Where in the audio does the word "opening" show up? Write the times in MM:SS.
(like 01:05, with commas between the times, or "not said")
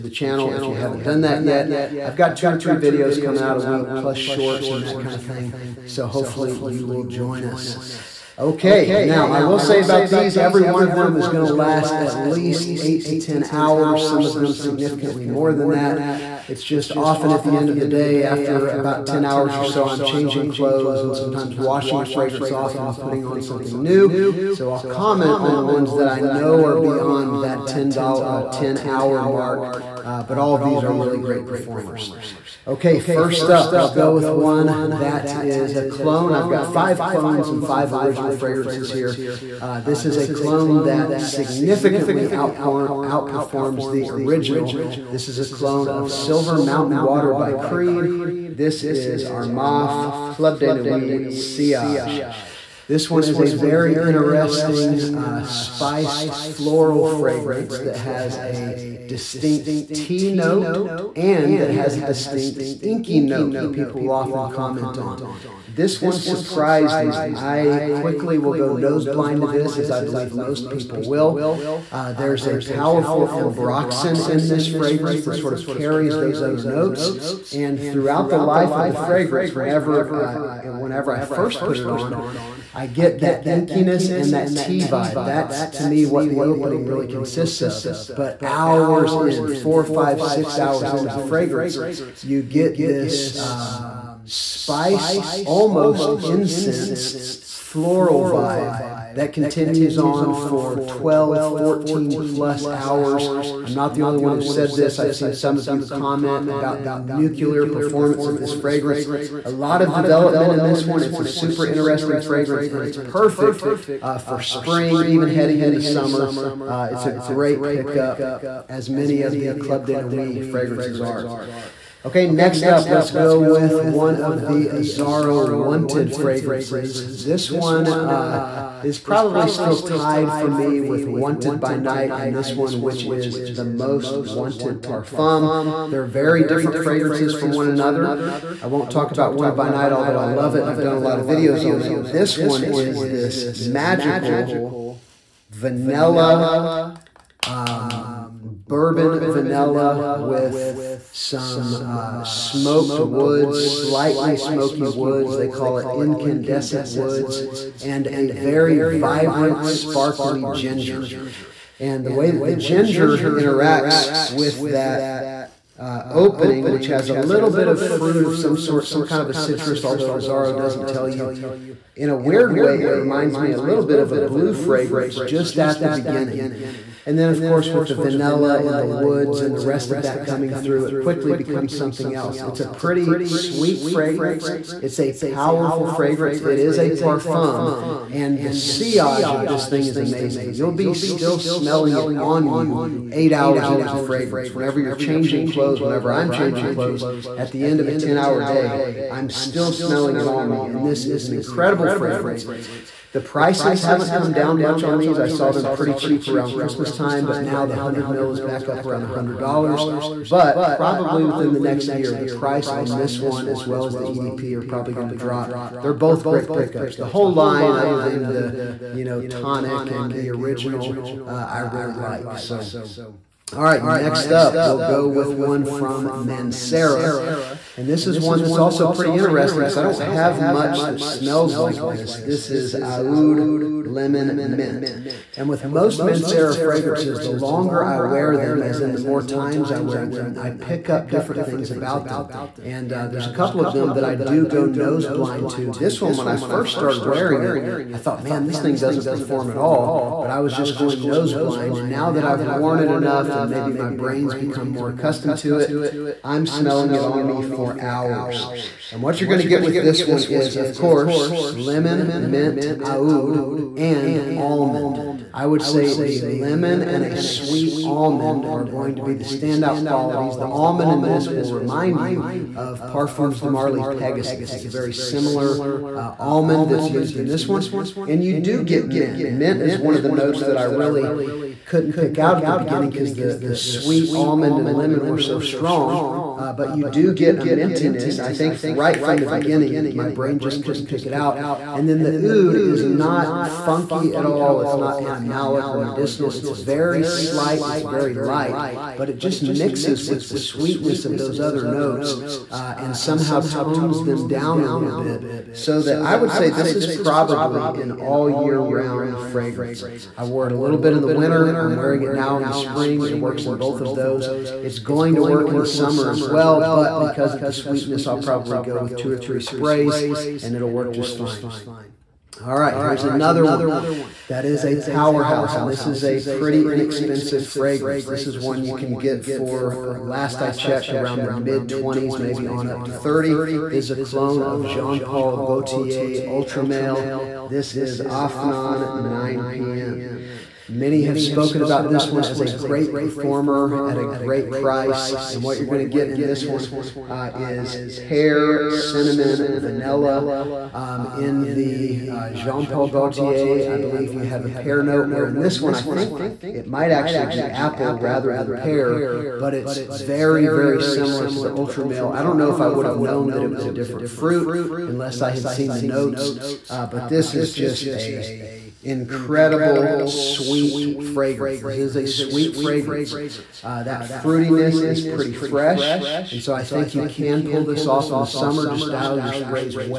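01:26, 02:46.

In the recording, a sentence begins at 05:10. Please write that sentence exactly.
I wore it a little bit in the winter.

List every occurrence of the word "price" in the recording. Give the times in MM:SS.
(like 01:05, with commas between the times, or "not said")
03:23, 03:32, 05:44.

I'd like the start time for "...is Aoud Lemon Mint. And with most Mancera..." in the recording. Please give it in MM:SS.
03:52.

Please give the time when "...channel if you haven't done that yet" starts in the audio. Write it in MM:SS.
00:00.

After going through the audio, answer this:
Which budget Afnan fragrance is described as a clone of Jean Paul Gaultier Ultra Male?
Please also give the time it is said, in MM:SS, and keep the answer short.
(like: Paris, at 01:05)
Afnan 9 p.m., at 05:37.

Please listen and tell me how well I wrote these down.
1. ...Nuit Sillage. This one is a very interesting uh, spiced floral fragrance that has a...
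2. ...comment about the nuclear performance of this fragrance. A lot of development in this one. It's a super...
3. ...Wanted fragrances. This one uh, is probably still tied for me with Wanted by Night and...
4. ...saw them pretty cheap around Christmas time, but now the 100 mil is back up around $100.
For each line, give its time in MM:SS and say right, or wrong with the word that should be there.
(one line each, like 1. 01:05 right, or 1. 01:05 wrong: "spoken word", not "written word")
1. 00:50 right
2. 01:45 right
3. 02:05 right
4. 03:25 right.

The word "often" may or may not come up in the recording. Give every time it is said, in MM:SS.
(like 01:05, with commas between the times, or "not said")
00:16, 01:04.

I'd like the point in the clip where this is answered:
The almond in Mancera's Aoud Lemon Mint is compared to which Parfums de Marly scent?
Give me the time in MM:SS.
04:33.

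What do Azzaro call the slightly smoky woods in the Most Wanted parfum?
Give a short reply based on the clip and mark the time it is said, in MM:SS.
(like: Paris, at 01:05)
incandescent woods, at 02:35.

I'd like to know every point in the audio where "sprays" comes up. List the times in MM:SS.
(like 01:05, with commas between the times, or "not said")
05:19, 06:19.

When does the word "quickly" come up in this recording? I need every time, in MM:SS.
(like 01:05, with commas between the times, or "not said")
01:07, 03:00.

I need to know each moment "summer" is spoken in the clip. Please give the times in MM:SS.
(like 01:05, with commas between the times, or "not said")
01:55, 05:15, 06:18.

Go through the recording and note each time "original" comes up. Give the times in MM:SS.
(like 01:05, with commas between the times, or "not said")
00:37, 00:44, 03:40.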